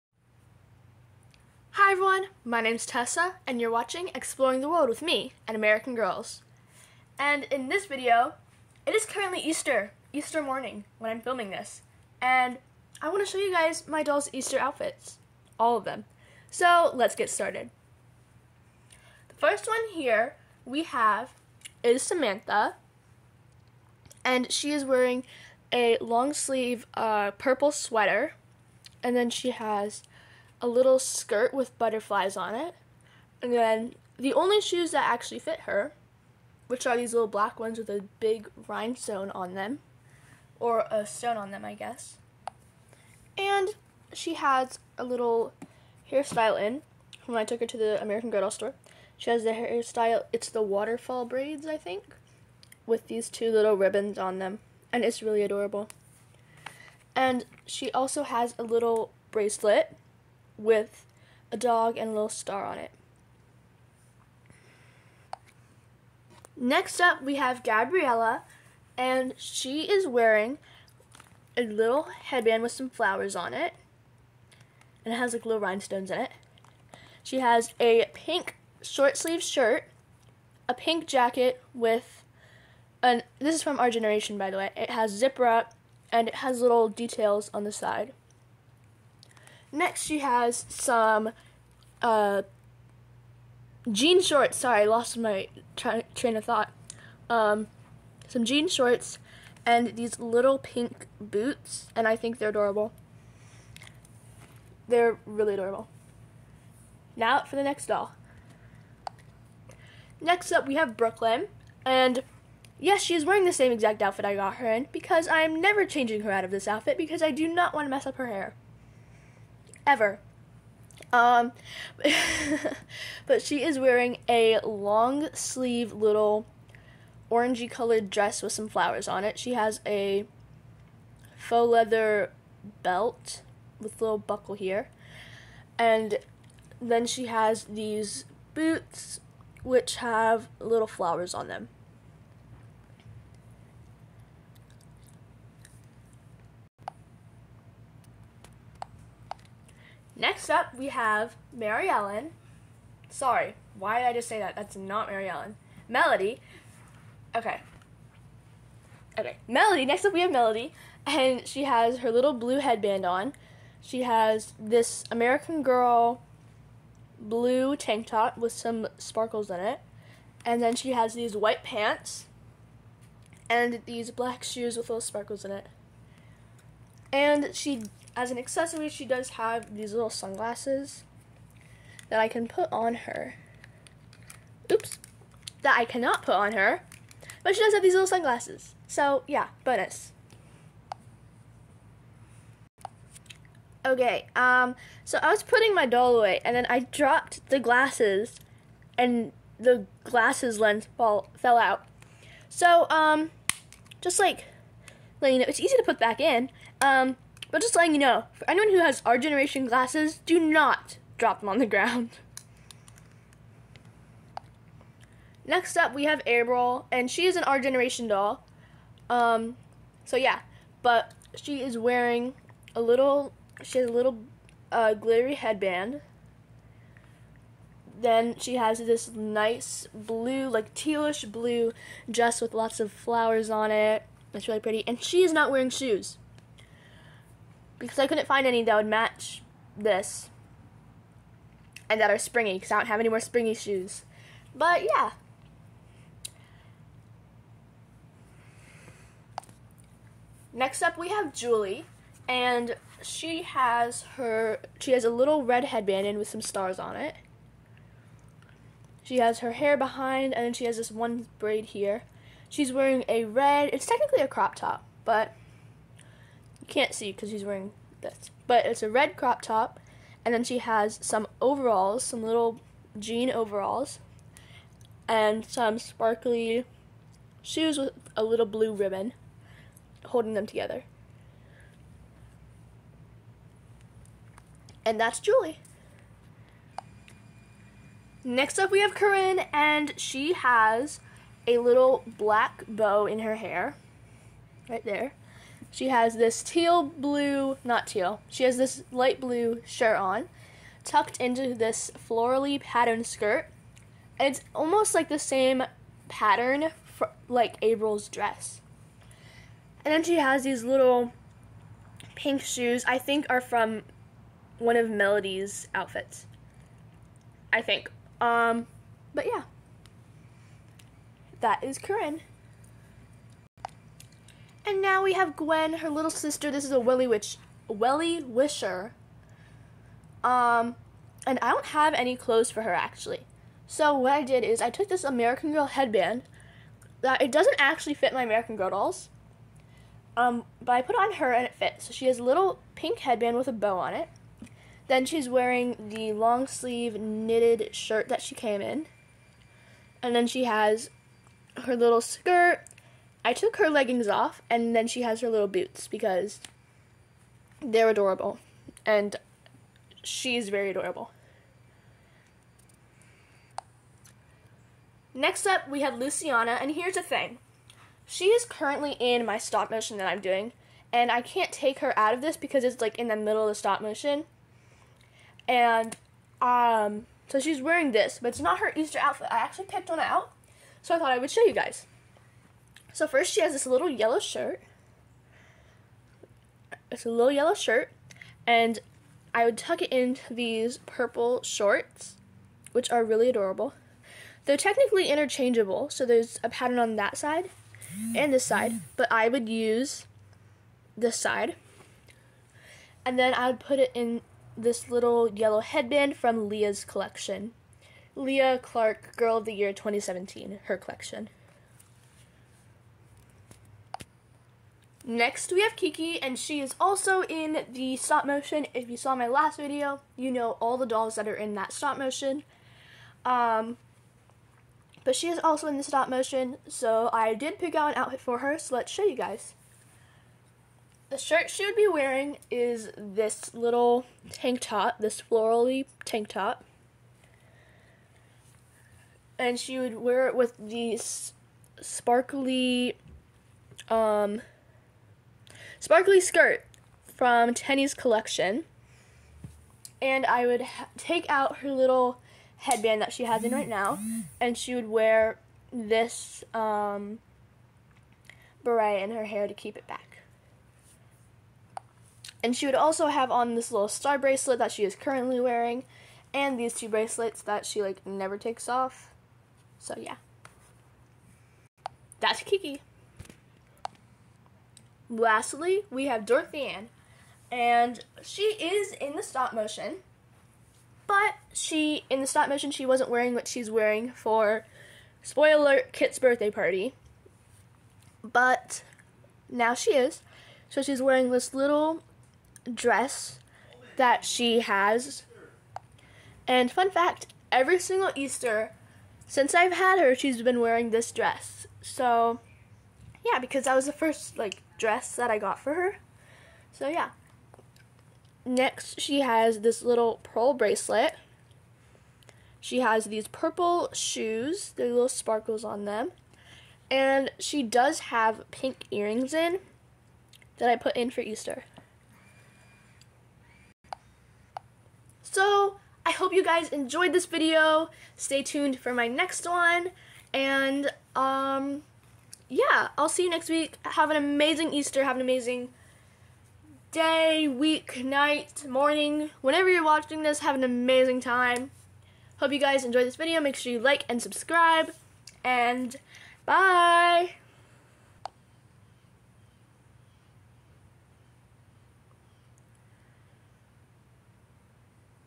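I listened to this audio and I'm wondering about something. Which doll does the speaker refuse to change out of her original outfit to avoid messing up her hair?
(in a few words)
Brooklyn.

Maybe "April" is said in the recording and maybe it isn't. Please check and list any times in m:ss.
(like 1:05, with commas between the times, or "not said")
3:36, 5:07.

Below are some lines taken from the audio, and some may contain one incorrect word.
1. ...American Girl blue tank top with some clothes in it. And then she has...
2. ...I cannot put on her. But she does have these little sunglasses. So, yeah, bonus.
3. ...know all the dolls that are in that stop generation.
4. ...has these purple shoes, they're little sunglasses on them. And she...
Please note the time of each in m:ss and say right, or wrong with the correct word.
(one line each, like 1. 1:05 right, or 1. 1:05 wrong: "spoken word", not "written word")
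1. 2:45 wrong: "sparkles", not "clothes"
2. 3:05 right
3. 7:00 wrong: "motion", not "generation"
4. 8:32 wrong: "sparkles", not "sunglasses".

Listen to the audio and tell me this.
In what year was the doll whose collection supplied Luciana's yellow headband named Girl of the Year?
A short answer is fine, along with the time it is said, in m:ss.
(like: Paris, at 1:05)
2017, at 6:49.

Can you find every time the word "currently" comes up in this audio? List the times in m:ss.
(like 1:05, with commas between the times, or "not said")
0:09, 6:08, 7:44.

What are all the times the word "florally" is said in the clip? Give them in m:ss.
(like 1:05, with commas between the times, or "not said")
5:02, 7:15.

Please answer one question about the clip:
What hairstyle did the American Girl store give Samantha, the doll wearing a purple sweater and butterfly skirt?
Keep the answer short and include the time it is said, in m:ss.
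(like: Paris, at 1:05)
Waterfall braids, at 0:50.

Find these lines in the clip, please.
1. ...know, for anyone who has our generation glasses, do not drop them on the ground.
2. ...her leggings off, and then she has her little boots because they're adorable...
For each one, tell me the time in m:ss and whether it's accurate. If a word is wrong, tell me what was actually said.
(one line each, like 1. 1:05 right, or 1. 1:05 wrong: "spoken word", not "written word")
1. 3:27 right
2. 5:53 right.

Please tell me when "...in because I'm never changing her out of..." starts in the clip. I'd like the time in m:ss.
1:54.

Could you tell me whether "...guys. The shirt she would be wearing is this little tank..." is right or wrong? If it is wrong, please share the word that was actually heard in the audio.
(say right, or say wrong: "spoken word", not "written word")
right.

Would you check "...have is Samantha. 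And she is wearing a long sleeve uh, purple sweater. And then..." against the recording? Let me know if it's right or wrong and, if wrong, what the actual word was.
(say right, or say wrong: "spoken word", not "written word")
right.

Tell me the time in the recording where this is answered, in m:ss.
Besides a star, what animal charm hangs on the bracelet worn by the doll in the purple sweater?
1:01.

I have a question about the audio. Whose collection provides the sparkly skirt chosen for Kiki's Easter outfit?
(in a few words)
Tenney's.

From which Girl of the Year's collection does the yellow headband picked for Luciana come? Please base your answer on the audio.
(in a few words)
Leah Clark.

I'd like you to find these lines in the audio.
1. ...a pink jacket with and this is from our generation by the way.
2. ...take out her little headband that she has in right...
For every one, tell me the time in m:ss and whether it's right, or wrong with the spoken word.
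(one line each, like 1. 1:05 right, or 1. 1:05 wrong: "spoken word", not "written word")
1. 1:20 right
2. 7:30 right.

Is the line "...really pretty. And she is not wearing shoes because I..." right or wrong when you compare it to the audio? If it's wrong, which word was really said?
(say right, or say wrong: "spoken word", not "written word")
right.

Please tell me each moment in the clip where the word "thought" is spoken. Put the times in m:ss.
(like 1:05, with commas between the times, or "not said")
1:36, 6:20.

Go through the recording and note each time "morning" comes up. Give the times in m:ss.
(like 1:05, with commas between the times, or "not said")
0:10, 8:58.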